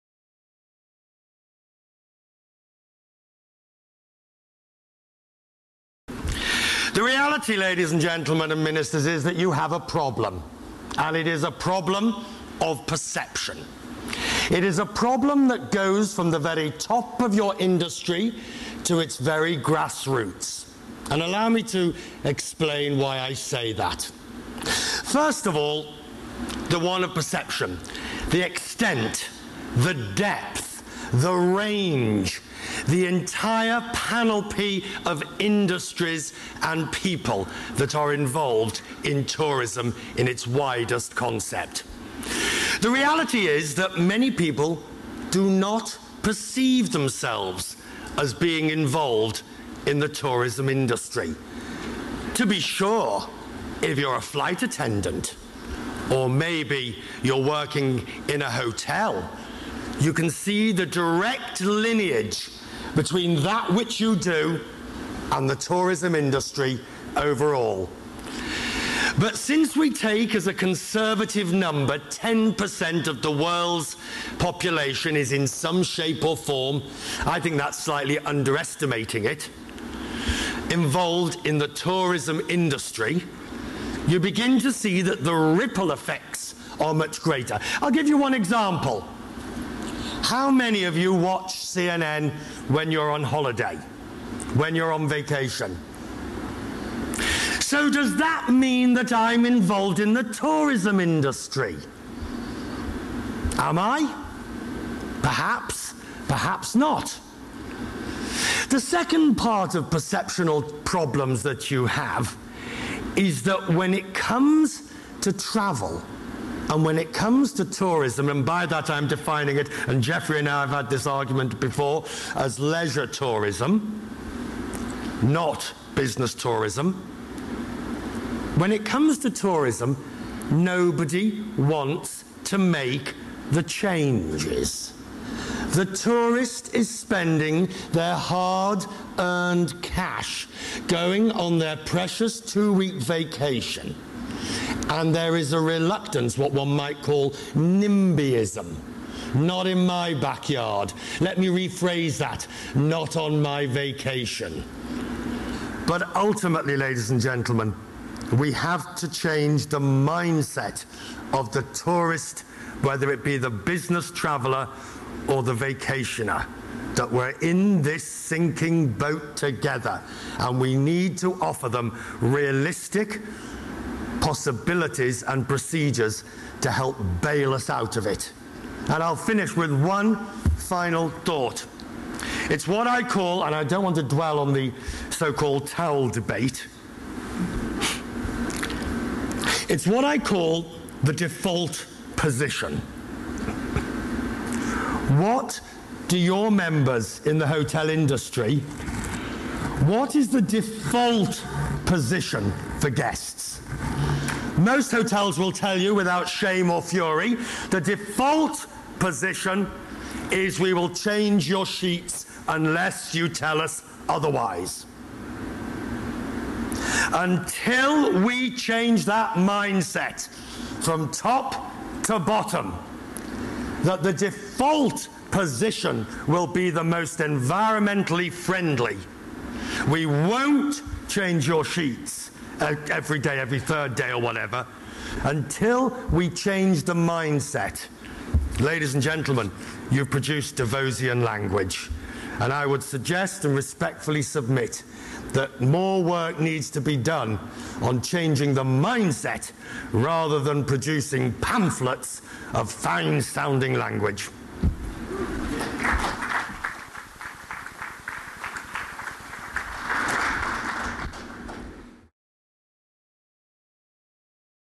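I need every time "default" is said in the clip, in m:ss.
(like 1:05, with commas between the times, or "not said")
3:11, 3:20, 3:27, 3:44.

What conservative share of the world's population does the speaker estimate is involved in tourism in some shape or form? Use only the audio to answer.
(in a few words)
10%.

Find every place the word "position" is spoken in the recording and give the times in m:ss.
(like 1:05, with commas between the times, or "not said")
3:12, 3:21, 3:28, 3:45.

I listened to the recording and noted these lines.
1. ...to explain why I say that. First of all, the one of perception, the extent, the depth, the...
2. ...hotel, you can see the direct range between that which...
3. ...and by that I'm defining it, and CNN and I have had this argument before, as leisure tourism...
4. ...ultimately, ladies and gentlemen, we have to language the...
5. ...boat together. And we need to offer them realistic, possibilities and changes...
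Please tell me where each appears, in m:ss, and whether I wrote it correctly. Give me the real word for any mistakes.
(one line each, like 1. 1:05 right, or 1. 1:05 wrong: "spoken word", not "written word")
1. 0:21 right
2. 0:58 wrong: "lineage", not "range"
3. 1:58 wrong: "Jeffrey", not "CNN"
4. 2:36 wrong: "change", not "language"
5. 2:48 wrong: "procedures", not "changes".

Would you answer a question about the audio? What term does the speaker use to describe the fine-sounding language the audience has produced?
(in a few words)
Davosian language.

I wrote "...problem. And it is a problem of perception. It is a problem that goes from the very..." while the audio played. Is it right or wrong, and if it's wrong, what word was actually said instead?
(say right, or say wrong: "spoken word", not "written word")
right.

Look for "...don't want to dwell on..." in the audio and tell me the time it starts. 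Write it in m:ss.
3:03.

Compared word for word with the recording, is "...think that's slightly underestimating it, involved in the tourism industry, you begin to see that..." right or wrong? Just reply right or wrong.
right.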